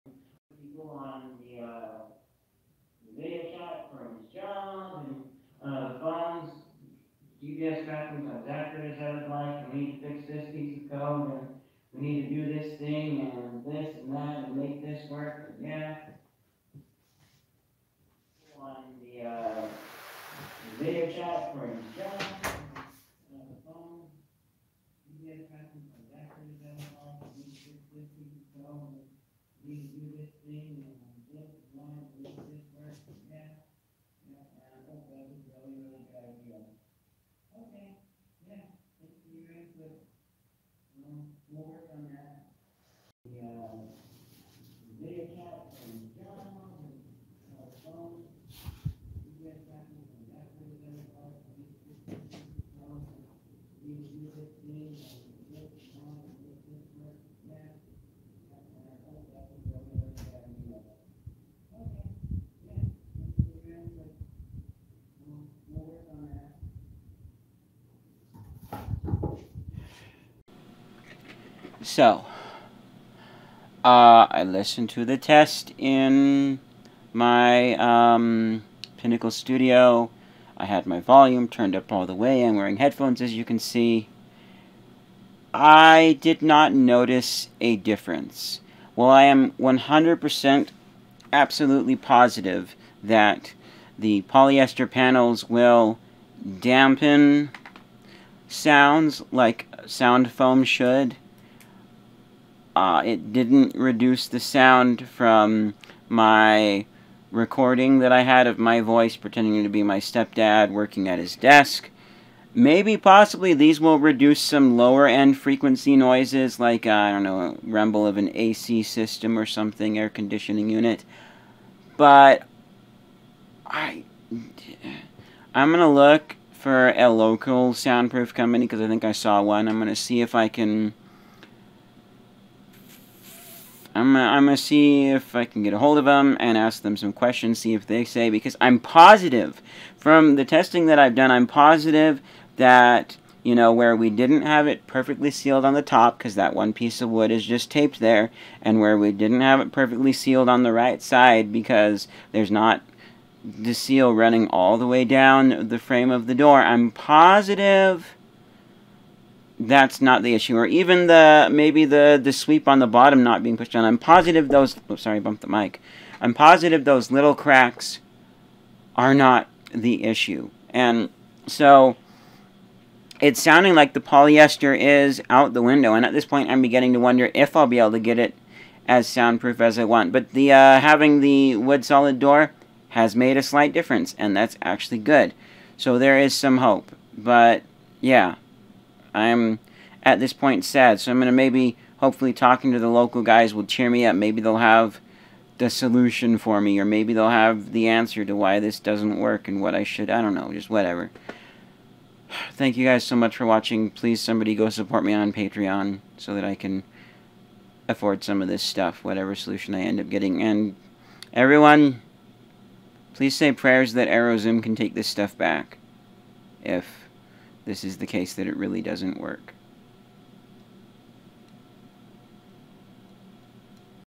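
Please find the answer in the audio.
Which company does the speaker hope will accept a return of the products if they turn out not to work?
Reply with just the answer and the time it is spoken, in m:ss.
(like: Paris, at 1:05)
Arrowzoom, at 3:34.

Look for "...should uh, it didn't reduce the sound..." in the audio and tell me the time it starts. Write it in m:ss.
1:40.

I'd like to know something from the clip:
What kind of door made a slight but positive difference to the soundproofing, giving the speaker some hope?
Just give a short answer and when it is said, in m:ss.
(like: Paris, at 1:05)
wood solid door, at 3:01.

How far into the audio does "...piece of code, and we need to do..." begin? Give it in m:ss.
0:10.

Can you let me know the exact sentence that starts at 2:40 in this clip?
Or even the maybe the, the sweep on the bottom not being pushed down.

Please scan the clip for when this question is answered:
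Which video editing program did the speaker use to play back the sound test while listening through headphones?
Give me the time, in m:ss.
1:18.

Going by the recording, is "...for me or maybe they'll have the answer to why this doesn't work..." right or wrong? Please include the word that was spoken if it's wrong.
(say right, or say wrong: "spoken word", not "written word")
right.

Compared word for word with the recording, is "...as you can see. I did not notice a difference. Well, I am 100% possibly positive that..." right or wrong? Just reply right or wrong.
wrong.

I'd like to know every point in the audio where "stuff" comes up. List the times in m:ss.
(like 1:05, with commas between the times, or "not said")
3:28, 3:35.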